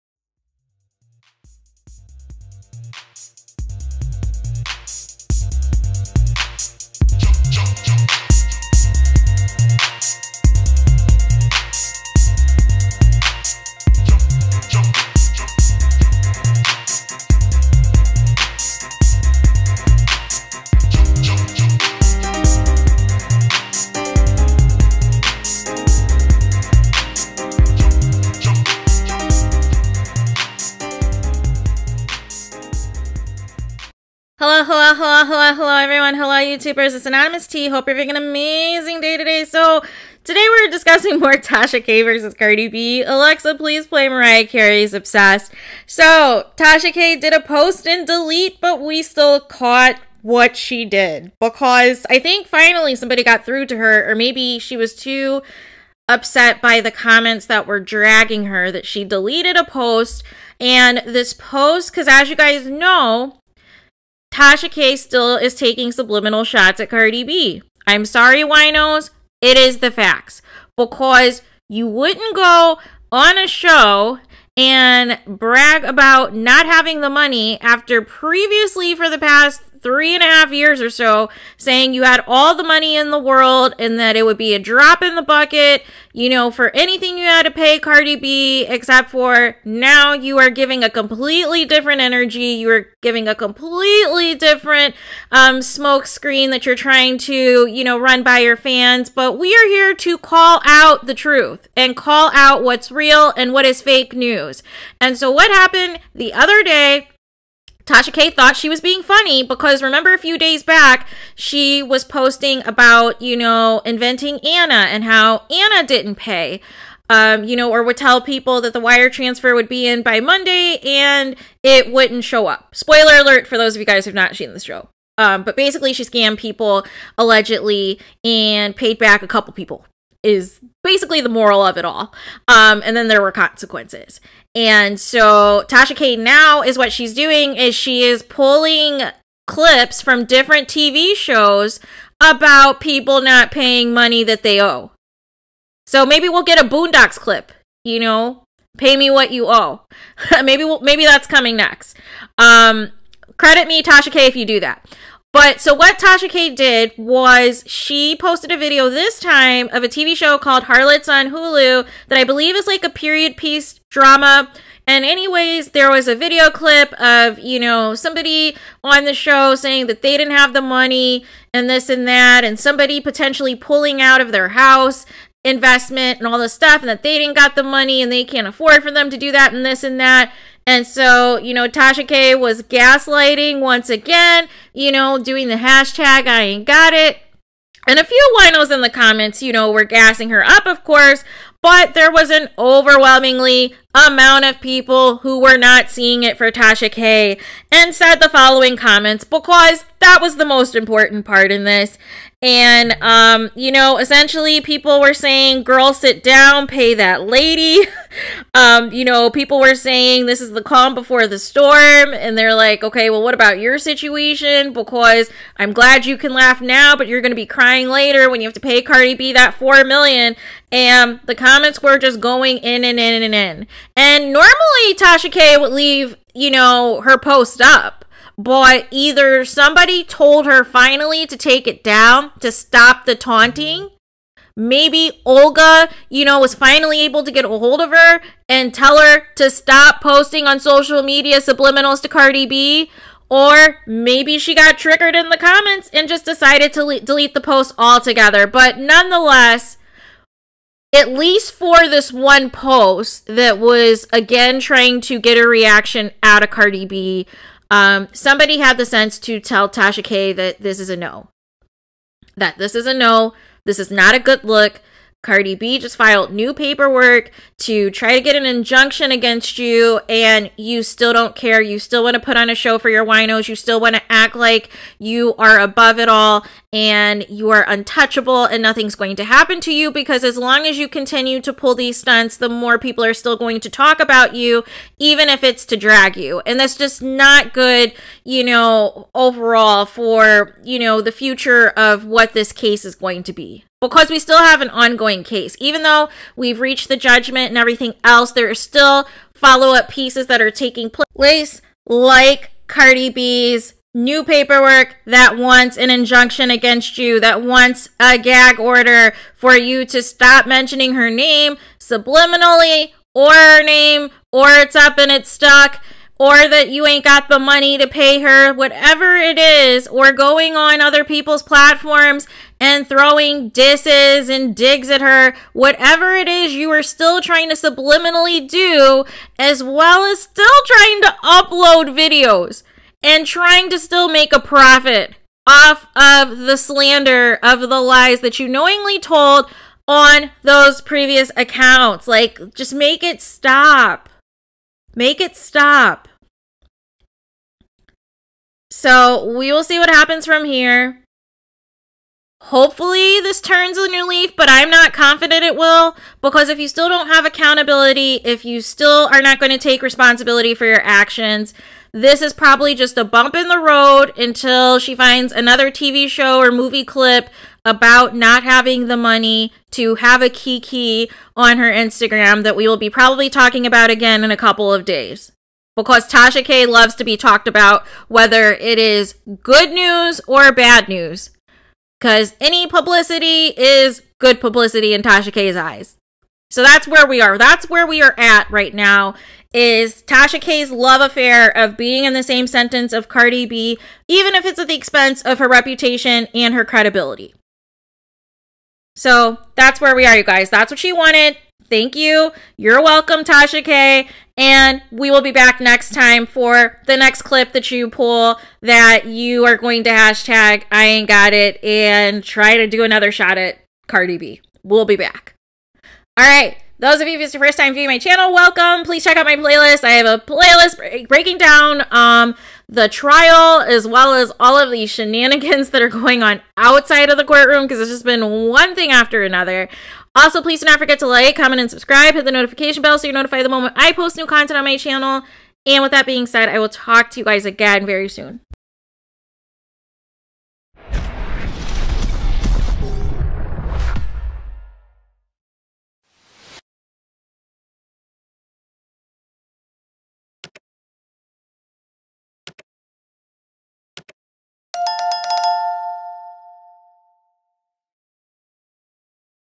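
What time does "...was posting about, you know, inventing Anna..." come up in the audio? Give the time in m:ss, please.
1:51.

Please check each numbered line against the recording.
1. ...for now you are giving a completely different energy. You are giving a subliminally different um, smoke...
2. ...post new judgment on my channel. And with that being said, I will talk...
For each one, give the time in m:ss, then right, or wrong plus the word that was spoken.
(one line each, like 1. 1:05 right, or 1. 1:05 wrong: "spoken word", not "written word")
1. 1:29 wrong: "completely", not "subliminally"
2. 7:13 wrong: "content", not "judgment".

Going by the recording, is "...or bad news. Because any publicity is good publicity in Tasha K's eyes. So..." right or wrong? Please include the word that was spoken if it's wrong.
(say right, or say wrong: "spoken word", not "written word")
right.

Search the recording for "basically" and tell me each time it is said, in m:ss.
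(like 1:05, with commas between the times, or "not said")
2:05, 2:10.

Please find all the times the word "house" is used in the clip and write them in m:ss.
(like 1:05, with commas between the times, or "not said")
2:54.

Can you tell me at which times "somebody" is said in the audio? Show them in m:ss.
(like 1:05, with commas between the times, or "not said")
0:52, 2:47, 2:52, 3:49, 4:18.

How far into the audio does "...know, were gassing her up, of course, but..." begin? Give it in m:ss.
3:09.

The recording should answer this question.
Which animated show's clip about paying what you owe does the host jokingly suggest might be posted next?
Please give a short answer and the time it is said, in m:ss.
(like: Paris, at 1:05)
Boondocks, at 2:26.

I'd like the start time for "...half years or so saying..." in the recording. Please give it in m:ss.
1:20.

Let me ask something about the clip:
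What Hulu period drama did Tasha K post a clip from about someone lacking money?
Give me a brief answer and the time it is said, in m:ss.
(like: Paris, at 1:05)
Harlots, at 2:40.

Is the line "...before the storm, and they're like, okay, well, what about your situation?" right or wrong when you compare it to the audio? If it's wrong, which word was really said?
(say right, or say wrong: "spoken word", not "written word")
right.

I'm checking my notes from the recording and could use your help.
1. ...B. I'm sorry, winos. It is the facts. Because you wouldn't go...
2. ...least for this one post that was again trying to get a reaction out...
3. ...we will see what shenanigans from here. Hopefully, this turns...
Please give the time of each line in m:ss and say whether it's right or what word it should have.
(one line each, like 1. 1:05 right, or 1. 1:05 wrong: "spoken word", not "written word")
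1. 1:07 right
2. 4:11 right
3. 5:49 wrong: "happens", not "shenanigans".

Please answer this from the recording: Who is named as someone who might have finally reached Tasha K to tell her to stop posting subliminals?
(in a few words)
Olga.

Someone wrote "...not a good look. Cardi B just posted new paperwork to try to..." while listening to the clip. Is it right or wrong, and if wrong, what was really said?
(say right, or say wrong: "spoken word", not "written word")
wrong: "filed", not "posted".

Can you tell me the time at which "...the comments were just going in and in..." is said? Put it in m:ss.
3:41.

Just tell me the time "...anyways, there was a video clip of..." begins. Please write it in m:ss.
2:45.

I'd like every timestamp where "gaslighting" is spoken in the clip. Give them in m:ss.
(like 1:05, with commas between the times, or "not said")
3:02.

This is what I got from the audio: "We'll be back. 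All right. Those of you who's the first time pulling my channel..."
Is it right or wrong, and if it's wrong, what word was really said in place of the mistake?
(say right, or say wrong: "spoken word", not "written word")
wrong: "viewing", not "pulling".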